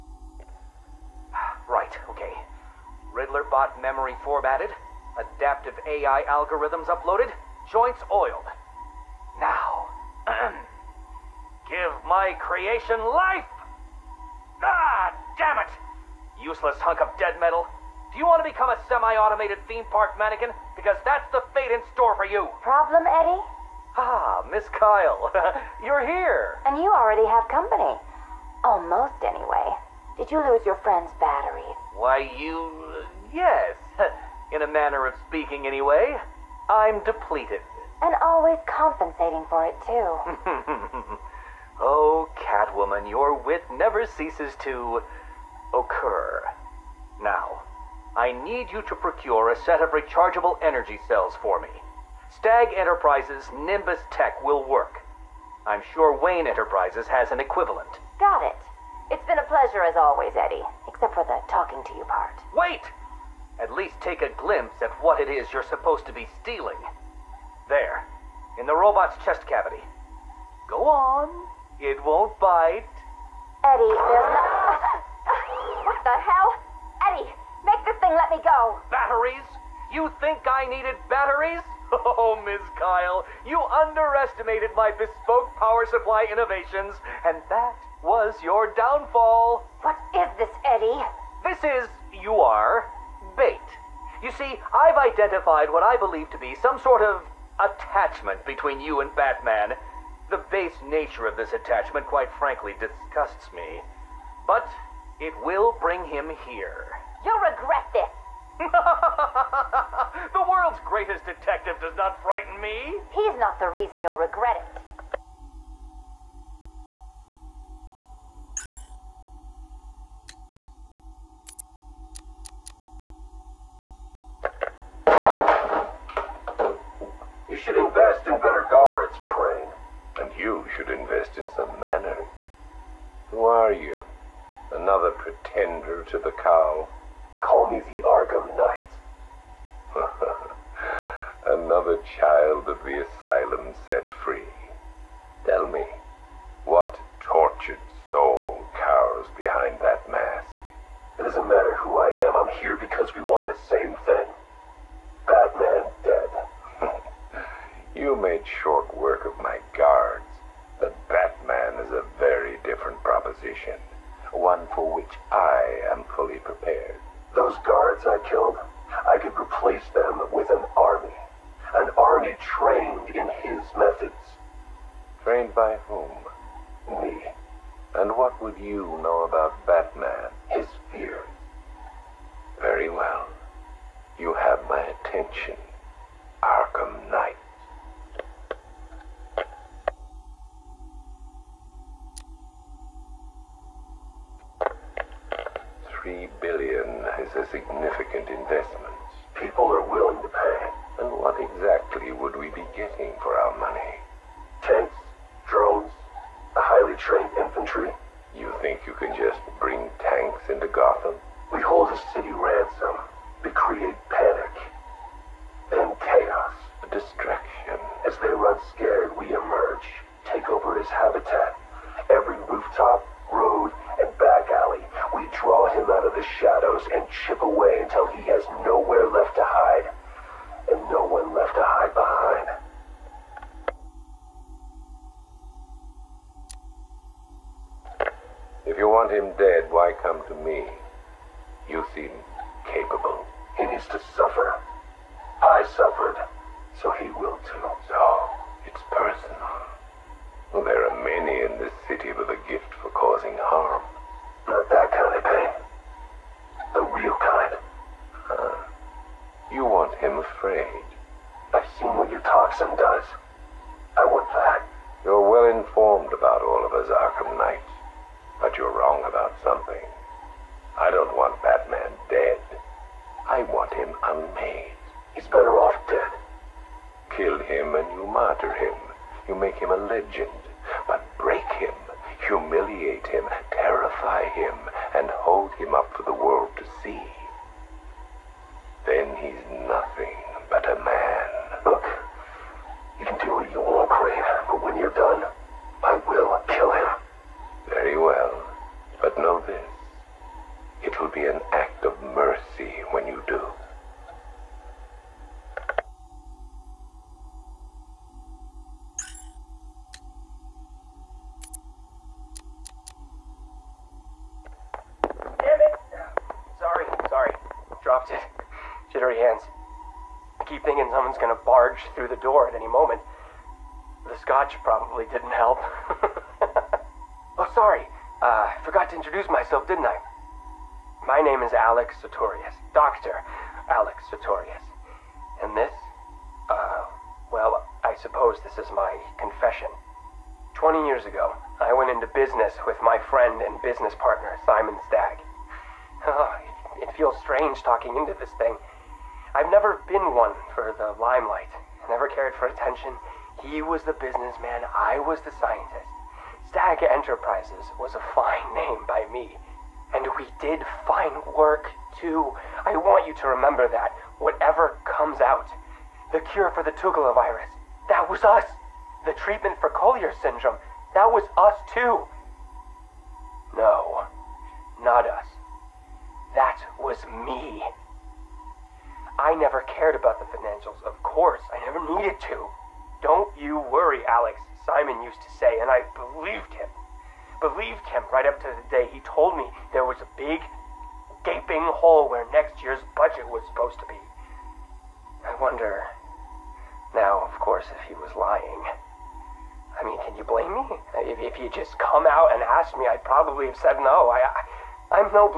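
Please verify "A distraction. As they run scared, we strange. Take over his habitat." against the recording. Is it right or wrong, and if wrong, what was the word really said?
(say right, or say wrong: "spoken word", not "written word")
wrong: "emerge", not "strange".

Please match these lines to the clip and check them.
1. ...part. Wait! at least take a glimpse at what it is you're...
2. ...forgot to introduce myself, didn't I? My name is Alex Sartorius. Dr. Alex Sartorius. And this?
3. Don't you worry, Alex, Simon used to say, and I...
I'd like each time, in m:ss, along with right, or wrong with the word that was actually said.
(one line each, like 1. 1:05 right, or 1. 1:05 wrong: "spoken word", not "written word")
1. 1:02 right
2. 5:28 right
3. 6:23 right.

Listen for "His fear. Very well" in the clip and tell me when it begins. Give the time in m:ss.
3:00.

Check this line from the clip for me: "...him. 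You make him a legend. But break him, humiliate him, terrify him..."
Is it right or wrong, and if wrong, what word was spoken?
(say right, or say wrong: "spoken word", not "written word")
right.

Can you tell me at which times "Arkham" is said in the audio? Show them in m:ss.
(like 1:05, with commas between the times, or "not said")
2:18, 3:06, 4:26.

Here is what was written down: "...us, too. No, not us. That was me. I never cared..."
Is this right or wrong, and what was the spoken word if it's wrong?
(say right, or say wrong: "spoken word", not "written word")
right.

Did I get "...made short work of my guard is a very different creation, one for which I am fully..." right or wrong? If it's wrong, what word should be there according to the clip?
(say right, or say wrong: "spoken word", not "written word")
wrong: "proposition", not "creation".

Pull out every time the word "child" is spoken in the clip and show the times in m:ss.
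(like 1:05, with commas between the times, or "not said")
2:22.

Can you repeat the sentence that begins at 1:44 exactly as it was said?
But it will bring him here.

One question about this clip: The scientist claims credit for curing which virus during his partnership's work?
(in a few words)
Tugela virus.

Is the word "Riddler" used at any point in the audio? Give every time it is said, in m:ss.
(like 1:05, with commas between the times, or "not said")
0:03.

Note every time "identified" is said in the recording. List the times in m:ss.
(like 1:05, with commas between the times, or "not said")
1:34.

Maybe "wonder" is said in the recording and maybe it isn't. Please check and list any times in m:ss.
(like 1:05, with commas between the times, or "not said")
6:35.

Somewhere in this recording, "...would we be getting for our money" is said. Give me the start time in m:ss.
3:22.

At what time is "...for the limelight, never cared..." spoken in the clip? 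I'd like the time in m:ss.
5:50.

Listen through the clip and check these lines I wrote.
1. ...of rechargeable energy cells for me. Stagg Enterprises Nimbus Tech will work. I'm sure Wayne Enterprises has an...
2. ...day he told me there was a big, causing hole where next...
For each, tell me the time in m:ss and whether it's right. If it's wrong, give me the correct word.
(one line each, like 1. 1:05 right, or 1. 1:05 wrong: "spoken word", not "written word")
1. 0:49 right
2. 6:28 wrong: "gaping", not "causing".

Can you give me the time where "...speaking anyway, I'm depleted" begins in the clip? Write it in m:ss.
0:35.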